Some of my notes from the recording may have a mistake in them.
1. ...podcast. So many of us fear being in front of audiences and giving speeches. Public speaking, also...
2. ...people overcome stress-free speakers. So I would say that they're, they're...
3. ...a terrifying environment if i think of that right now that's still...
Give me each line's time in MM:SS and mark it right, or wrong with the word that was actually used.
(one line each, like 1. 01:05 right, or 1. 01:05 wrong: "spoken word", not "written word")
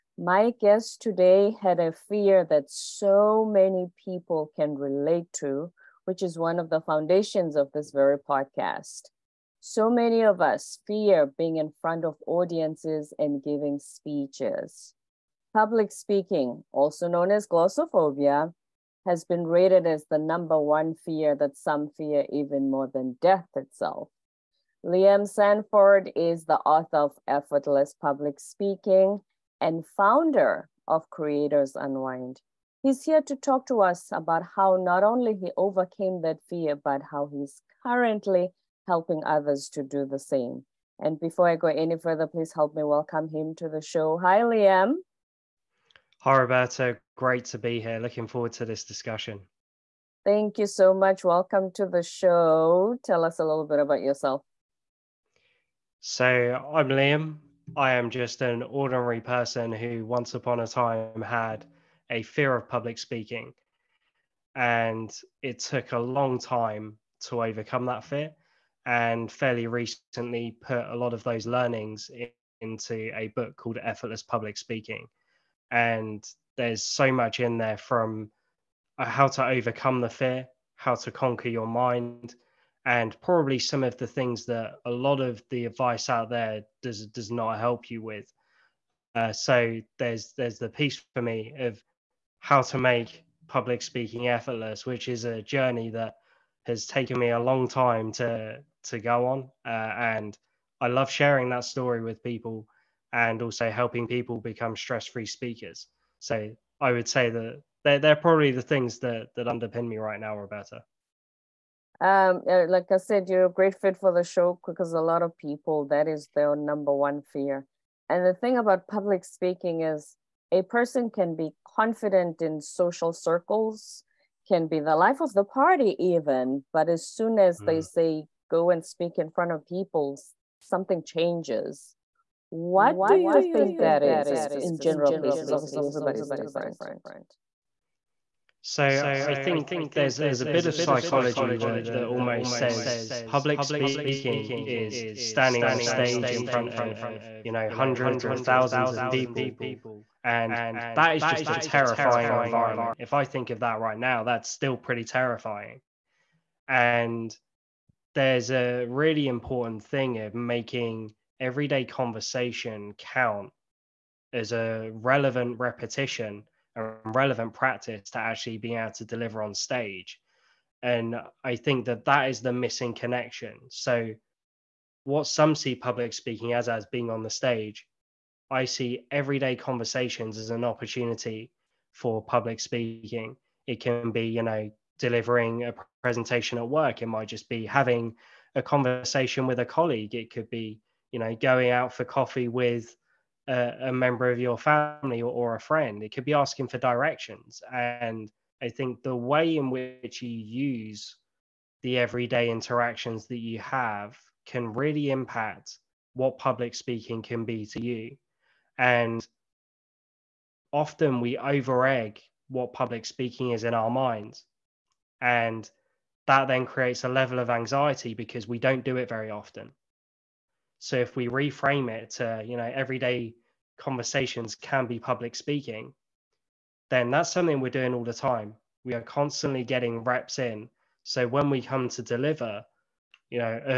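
1. 00:08 right
2. 01:44 wrong: "become", not "overcome"
3. 02:31 right.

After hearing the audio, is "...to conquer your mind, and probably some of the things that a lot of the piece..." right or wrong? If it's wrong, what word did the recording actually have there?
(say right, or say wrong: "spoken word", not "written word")
wrong: "advice", not "piece".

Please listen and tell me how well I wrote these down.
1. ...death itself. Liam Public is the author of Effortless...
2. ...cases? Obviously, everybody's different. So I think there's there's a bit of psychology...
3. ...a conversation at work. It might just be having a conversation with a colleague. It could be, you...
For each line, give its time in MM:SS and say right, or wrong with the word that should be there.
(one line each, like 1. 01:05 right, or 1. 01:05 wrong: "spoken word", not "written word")
1. 00:23 wrong: "Sandford", not "Public"
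2. 02:15 right
3. 03:05 wrong: "presentation", not "conversation".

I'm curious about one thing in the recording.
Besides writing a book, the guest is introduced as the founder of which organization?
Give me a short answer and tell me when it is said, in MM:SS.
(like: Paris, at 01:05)
Creators Unwind, at 00:31.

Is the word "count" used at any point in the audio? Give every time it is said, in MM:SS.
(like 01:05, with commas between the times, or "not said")
02:42.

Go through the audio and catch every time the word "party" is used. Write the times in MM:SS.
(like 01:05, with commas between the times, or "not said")
02:05.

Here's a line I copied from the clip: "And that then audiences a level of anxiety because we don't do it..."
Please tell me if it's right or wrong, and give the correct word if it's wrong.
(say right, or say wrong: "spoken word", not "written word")
wrong: "creates", not "audiences".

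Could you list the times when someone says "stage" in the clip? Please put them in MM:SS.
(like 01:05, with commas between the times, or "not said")
02:25, 02:49, 02:57.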